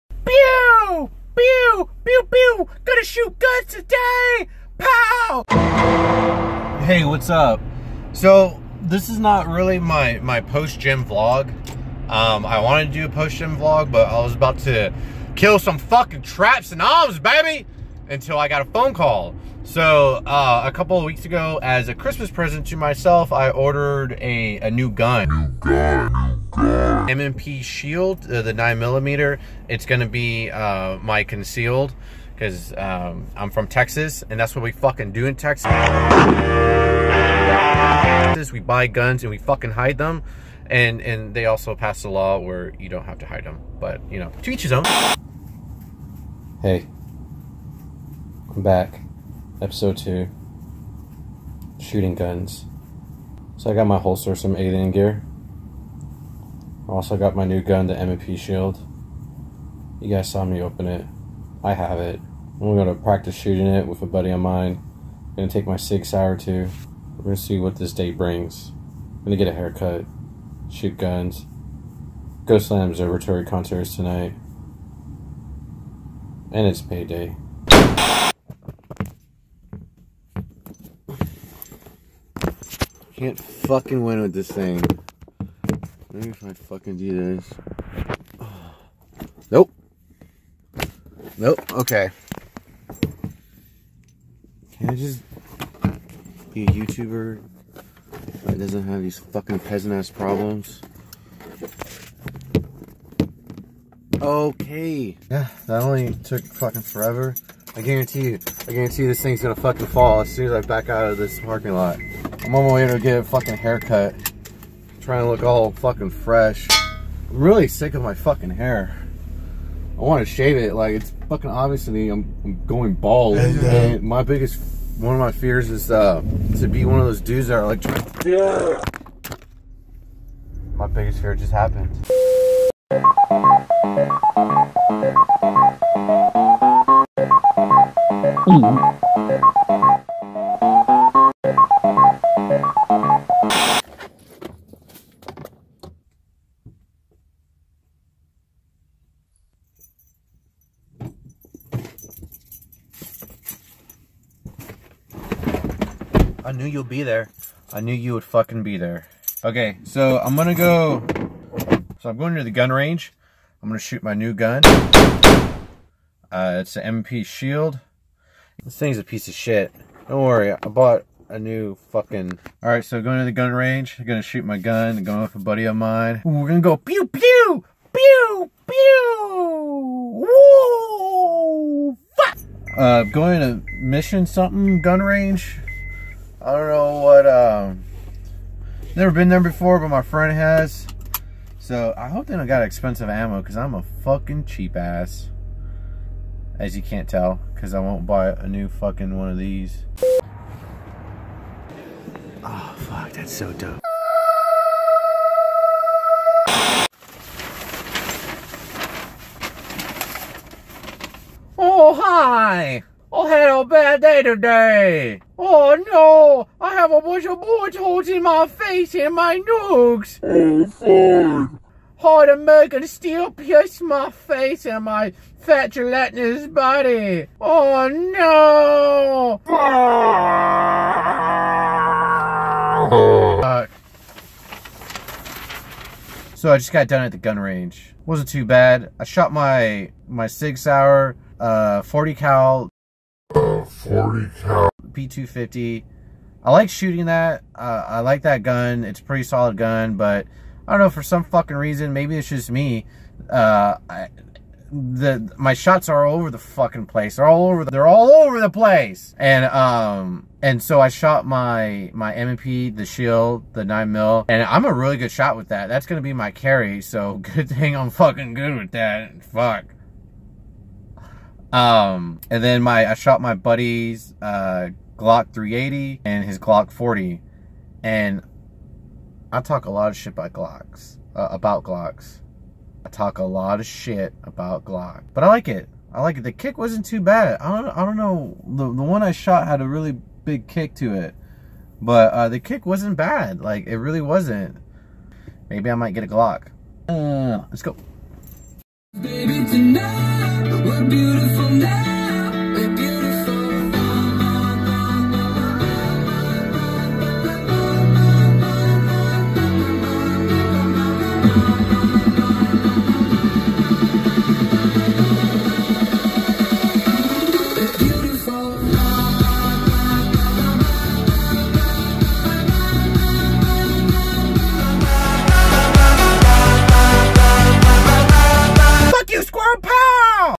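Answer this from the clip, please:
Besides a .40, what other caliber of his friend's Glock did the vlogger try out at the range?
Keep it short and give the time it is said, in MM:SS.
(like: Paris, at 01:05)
380, at 04:35.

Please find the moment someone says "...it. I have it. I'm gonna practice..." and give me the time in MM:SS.
01:00.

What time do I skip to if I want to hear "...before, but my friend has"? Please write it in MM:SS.
03:09.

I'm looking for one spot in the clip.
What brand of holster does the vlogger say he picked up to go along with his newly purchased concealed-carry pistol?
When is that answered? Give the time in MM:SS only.
00:54.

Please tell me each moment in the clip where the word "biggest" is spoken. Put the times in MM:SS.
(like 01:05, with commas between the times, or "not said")
02:04, 02:10.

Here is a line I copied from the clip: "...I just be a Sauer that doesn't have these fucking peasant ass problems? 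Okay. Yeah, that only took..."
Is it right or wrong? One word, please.
wrong.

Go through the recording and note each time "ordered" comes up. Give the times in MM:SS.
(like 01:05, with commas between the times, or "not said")
00:23.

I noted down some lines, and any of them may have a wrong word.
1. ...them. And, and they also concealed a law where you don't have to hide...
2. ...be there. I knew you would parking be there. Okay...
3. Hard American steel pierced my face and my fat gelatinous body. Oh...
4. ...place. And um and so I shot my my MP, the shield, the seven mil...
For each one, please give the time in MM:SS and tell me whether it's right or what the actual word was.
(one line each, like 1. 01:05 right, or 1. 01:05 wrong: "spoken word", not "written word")
1. 00:39 wrong: "passed", not "concealed"
2. 02:36 wrong: "fucking", not "parking"
3. 03:41 right
4. 04:18 wrong: "nine", not "seven".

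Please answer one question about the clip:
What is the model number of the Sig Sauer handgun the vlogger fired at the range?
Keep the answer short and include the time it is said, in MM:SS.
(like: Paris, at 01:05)
P250, at 04:04.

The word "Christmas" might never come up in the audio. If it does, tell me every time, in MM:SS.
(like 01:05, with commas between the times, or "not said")
00:21.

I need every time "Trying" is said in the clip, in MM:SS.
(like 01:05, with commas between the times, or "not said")
01:54.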